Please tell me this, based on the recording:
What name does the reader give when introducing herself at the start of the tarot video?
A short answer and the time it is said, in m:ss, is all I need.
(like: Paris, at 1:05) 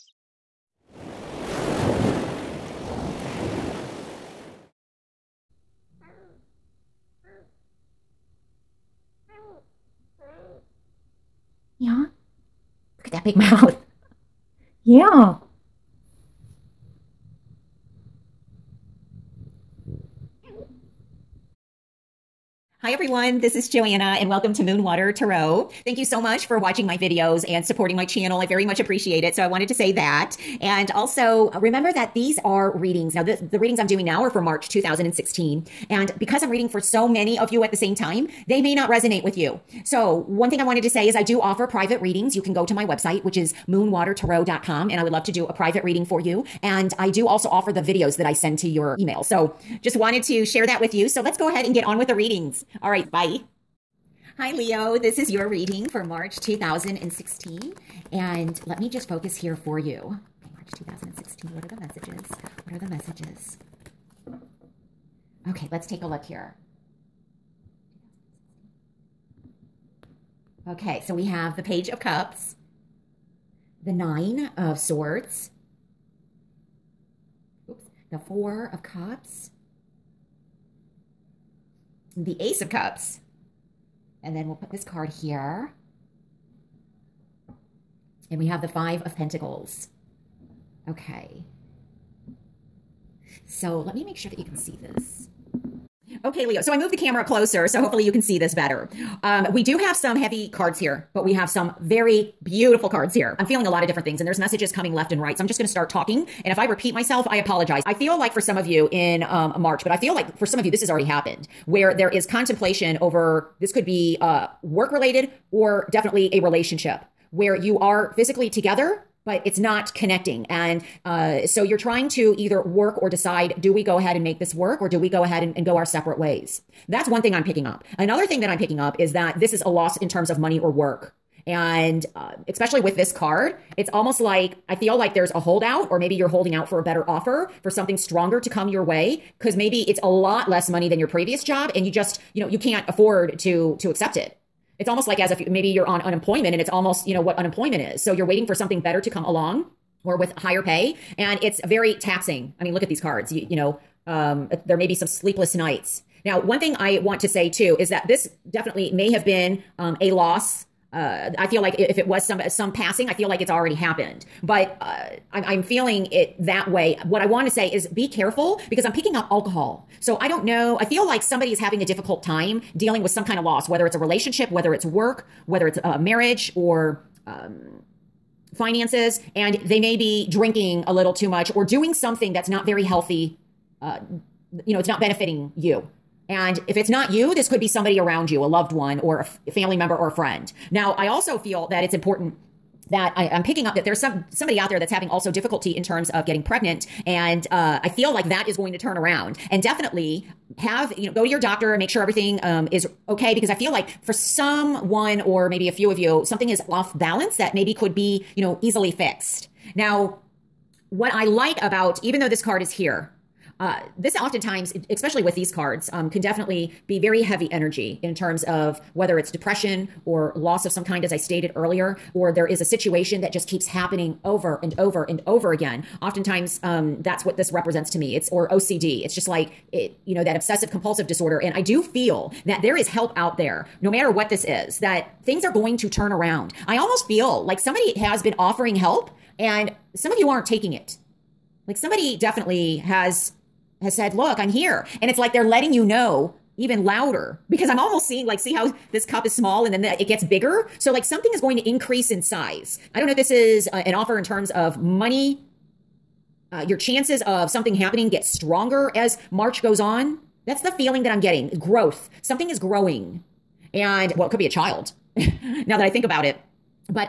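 Joana, at 0:23.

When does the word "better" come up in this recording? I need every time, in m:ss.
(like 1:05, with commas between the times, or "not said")
1:38, 2:16, 2:28.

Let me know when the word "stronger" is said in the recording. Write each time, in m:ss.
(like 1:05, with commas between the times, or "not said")
2:17, 4:18.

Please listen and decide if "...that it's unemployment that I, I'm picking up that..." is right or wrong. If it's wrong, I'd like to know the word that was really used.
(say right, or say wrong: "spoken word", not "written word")
wrong: "important", not "unemployment".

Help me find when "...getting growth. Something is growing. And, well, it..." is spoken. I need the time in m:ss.
4:21.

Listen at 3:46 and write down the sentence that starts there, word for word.
Oftentimes, um, that's what this represents to me.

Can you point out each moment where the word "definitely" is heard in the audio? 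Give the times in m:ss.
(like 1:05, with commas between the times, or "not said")
1:55, 2:38, 3:19, 3:36, 4:02.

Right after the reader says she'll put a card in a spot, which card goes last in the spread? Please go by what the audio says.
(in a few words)
Five of Pentacles.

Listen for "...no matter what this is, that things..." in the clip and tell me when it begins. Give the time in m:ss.
3:53.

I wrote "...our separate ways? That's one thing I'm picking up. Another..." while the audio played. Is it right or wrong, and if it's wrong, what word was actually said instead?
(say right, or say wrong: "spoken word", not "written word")
right.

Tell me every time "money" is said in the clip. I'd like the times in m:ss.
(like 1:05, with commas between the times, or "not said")
2:10, 2:20, 4:14.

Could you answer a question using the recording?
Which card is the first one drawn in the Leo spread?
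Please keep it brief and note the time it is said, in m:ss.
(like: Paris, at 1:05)
Page of Cups, at 1:11.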